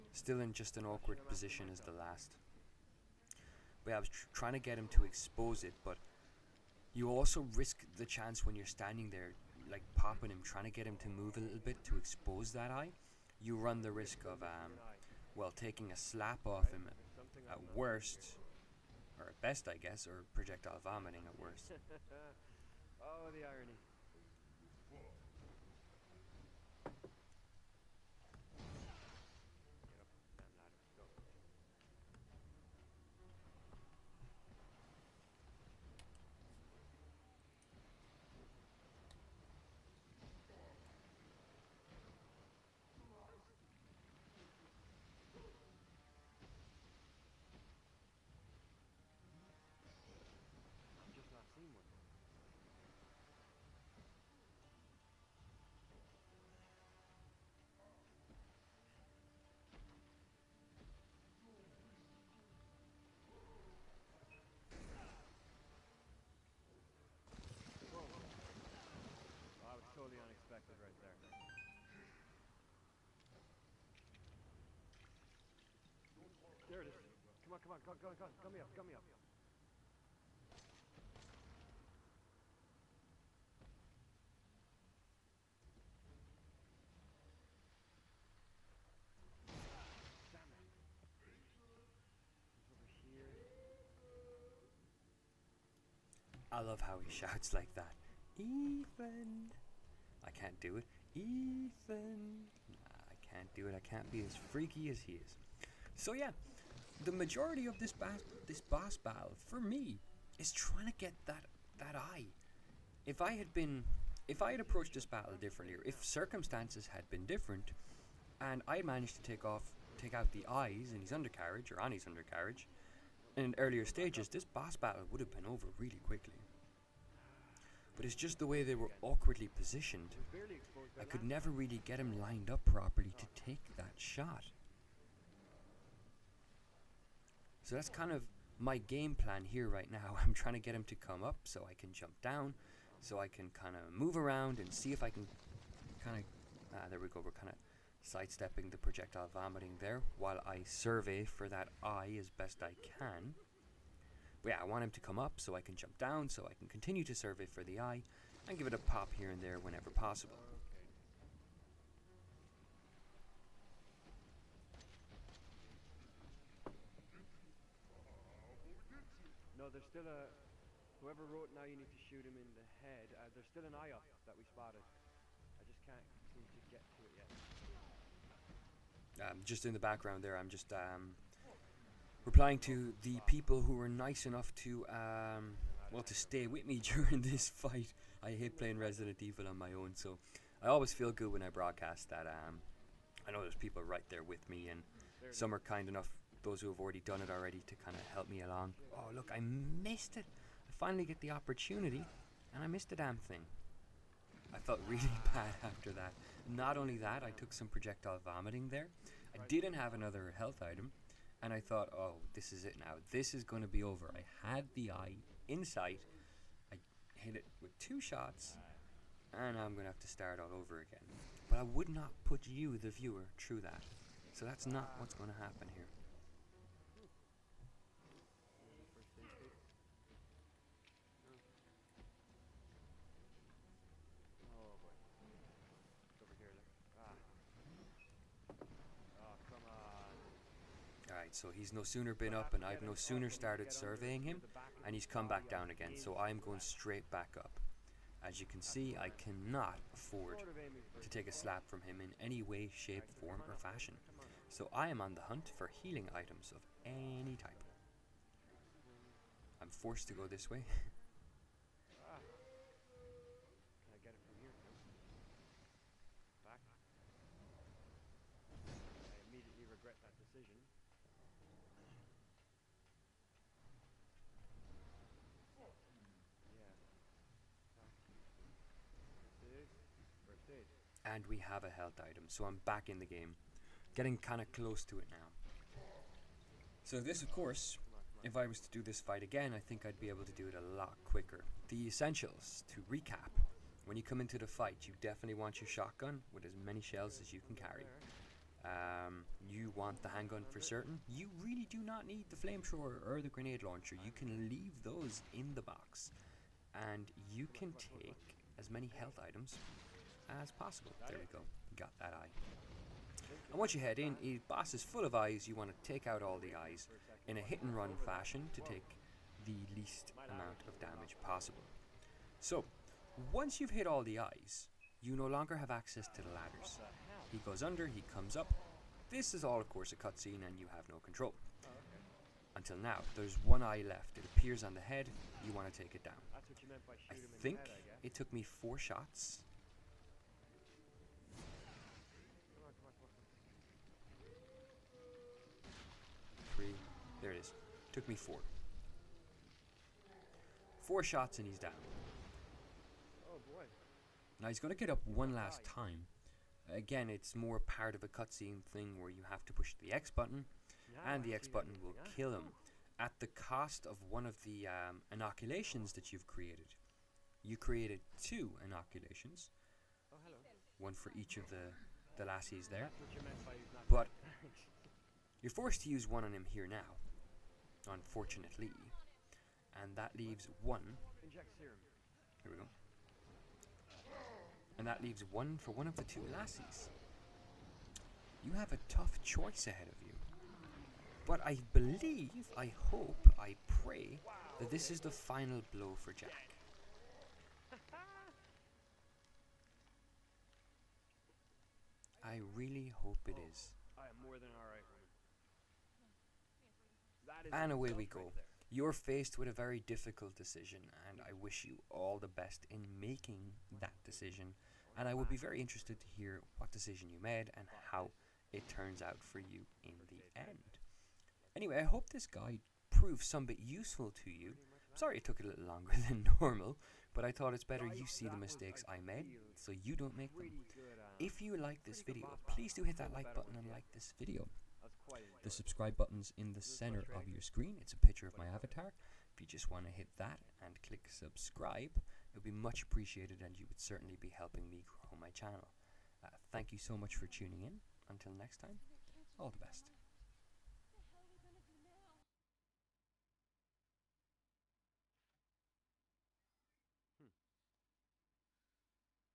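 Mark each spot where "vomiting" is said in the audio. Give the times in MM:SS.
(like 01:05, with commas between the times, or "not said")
00:20, 02:29, 03:28.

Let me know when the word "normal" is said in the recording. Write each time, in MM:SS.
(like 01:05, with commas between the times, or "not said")
07:06.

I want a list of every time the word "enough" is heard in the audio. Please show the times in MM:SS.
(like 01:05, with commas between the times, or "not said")
03:04, 03:15.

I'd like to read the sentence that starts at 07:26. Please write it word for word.
Uh, thank you so much for tuning in.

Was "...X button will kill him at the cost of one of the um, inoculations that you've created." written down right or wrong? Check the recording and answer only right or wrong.
right.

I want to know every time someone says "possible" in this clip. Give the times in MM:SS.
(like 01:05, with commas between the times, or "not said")
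02:39, 05:10, 05:21.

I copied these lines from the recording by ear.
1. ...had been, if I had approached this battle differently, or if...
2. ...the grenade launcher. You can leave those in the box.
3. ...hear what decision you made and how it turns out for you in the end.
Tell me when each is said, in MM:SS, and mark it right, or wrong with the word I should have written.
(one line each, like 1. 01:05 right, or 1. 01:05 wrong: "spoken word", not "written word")
1. 01:53 right
2. 05:03 right
3. 06:56 right.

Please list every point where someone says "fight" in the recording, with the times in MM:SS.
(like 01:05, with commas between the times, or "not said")
03:07, 04:48, 04:54.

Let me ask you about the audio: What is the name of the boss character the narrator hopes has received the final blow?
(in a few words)
Jack.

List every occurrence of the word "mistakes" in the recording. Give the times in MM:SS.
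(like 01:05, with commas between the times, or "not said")
07:08.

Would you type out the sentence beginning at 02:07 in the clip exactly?
But it's just the way they were awkwardly positioned.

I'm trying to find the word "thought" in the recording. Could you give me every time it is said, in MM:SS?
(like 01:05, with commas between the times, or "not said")
03:31, 07:07.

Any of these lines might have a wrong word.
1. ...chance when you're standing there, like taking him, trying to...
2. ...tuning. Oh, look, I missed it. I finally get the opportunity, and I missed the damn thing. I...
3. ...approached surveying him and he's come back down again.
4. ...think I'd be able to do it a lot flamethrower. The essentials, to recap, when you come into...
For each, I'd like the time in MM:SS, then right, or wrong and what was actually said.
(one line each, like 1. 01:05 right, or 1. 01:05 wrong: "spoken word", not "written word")
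1. 00:08 wrong: "popping", not "taking"
2. 03:18 wrong: "along", not "tuning"
3. 04:03 wrong: "started", not "approached"
4. 04:49 wrong: "quicker", not "flamethrower".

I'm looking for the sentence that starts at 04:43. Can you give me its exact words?
Getting kinda close to it now.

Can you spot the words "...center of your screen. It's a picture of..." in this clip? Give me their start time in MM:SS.
07:16.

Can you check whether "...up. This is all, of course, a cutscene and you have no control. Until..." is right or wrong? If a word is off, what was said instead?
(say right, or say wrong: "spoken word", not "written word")
right.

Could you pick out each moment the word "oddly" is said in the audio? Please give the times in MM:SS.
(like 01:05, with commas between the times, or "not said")
not said.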